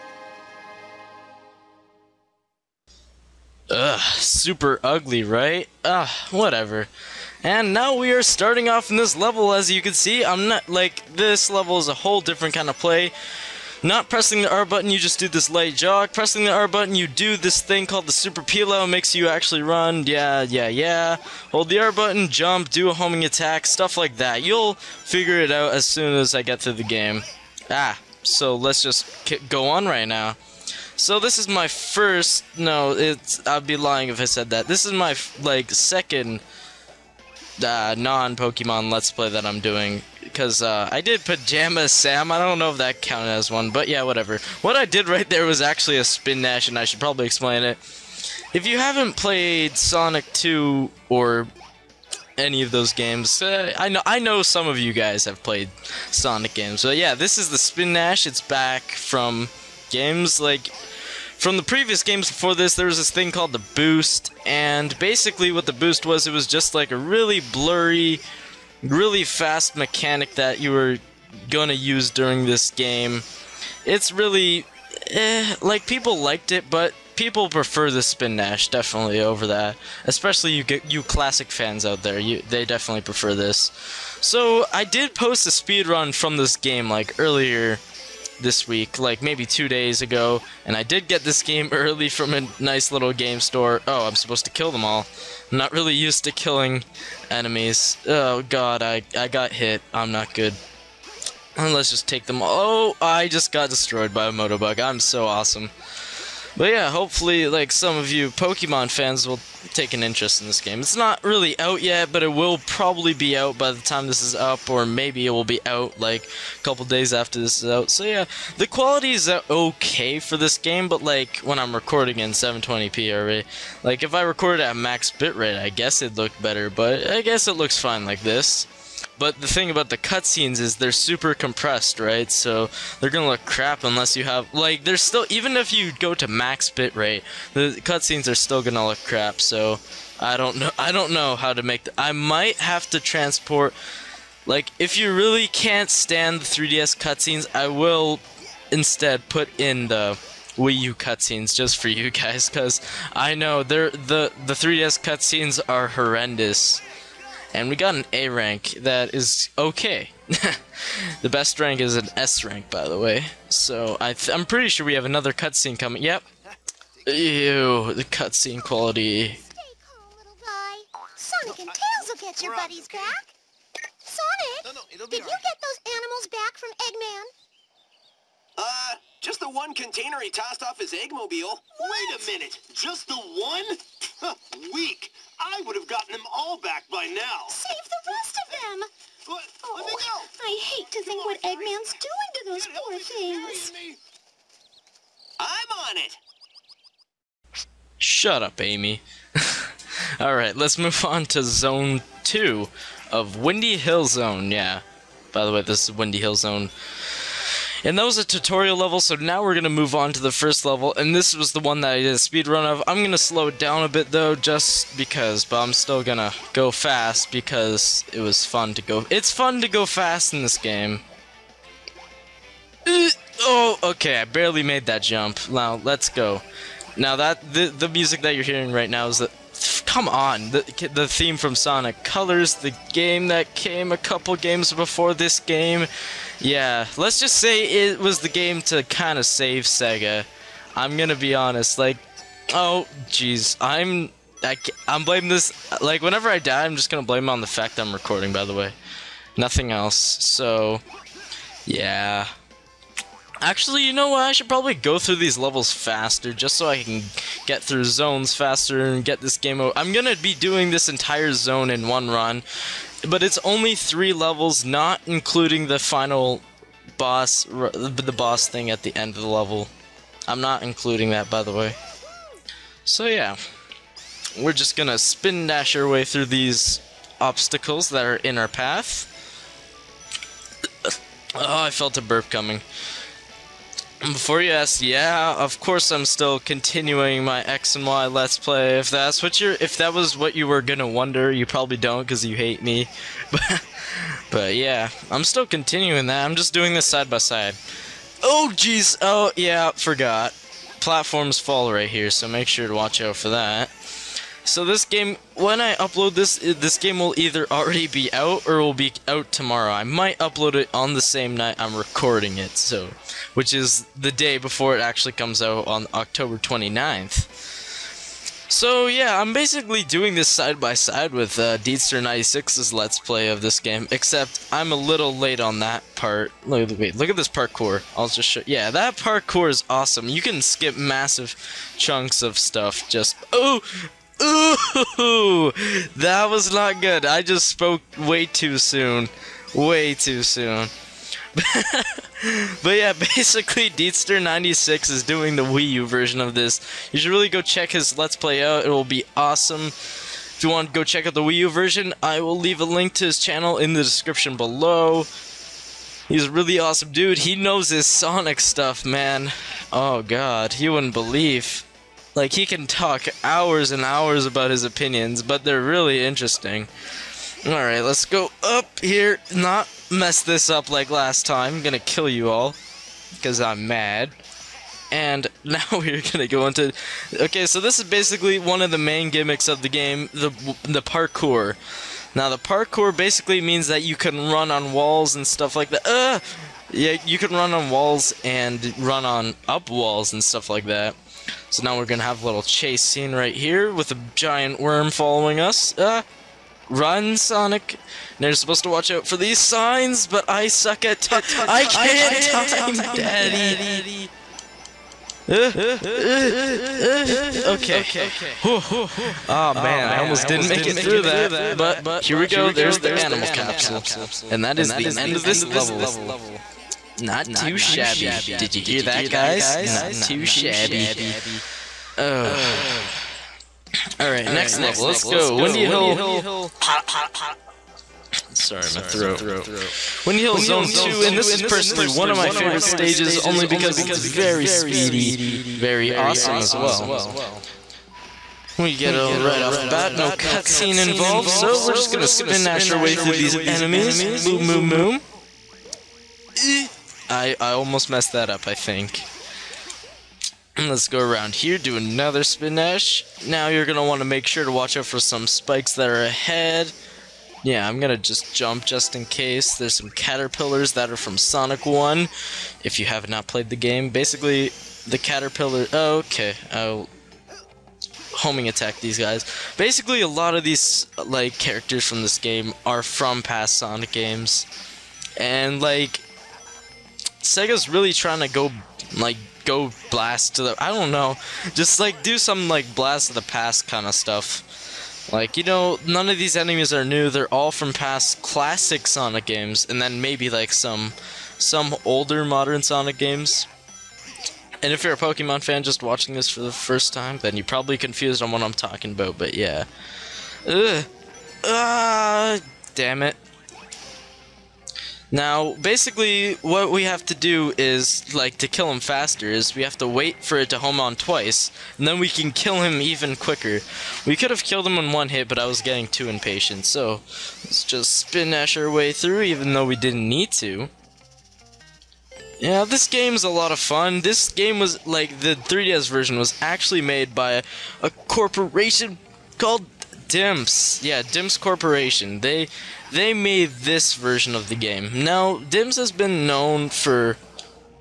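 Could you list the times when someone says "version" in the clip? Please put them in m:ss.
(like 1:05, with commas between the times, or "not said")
5:45, 5:51, 8:45, 8:53.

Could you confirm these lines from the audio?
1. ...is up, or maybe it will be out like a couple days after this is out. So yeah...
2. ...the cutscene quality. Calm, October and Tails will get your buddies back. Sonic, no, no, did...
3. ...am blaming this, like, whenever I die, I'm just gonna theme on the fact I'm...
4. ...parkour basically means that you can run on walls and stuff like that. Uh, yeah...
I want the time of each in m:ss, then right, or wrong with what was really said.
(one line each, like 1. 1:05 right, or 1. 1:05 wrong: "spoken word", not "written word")
1. 1:54 right
2. 2:47 wrong: "Sonic", not "October"
3. 4:04 wrong: "blame", not "theme"
4. 6:22 right.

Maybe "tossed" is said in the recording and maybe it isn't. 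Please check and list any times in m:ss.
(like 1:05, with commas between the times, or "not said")
3:00.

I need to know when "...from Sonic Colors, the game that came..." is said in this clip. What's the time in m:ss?
3:51.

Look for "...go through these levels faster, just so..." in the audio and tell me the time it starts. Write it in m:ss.
4:14.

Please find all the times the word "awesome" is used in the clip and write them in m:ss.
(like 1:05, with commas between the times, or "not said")
1:45, 5:29, 5:49, 5:56, 7:15.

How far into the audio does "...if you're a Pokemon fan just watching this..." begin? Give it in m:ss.
8:14.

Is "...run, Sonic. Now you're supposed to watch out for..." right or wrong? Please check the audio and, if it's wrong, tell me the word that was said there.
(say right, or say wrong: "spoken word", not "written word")
right.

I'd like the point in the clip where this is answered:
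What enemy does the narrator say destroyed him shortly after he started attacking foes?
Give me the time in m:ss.
1:44.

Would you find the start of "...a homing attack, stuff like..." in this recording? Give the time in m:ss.
0:22.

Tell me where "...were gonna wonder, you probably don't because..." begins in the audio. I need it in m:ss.
4:50.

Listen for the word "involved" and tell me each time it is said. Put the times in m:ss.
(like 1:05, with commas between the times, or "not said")
7:20.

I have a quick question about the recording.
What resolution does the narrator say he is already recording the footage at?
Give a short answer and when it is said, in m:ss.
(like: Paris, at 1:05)
720p, at 2:02.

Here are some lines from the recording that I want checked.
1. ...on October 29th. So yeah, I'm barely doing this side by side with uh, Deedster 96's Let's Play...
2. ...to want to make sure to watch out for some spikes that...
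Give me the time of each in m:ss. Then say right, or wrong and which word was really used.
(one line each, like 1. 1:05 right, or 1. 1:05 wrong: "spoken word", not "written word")
1. 5:15 wrong: "basically", not "barely"
2. 7:33 right.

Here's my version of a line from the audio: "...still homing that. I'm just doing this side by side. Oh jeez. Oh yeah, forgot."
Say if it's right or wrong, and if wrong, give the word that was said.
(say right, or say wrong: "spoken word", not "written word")
wrong: "continuing", not "homing".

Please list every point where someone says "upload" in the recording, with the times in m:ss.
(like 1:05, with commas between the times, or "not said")
5:05, 5:10.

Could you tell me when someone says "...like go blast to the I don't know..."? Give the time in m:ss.
7:58.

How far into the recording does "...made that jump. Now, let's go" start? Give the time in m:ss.
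3:44.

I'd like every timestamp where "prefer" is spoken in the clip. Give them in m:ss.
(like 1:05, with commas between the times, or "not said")
1:17, 1:23.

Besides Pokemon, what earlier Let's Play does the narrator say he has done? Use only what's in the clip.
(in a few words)
Pajama Sam.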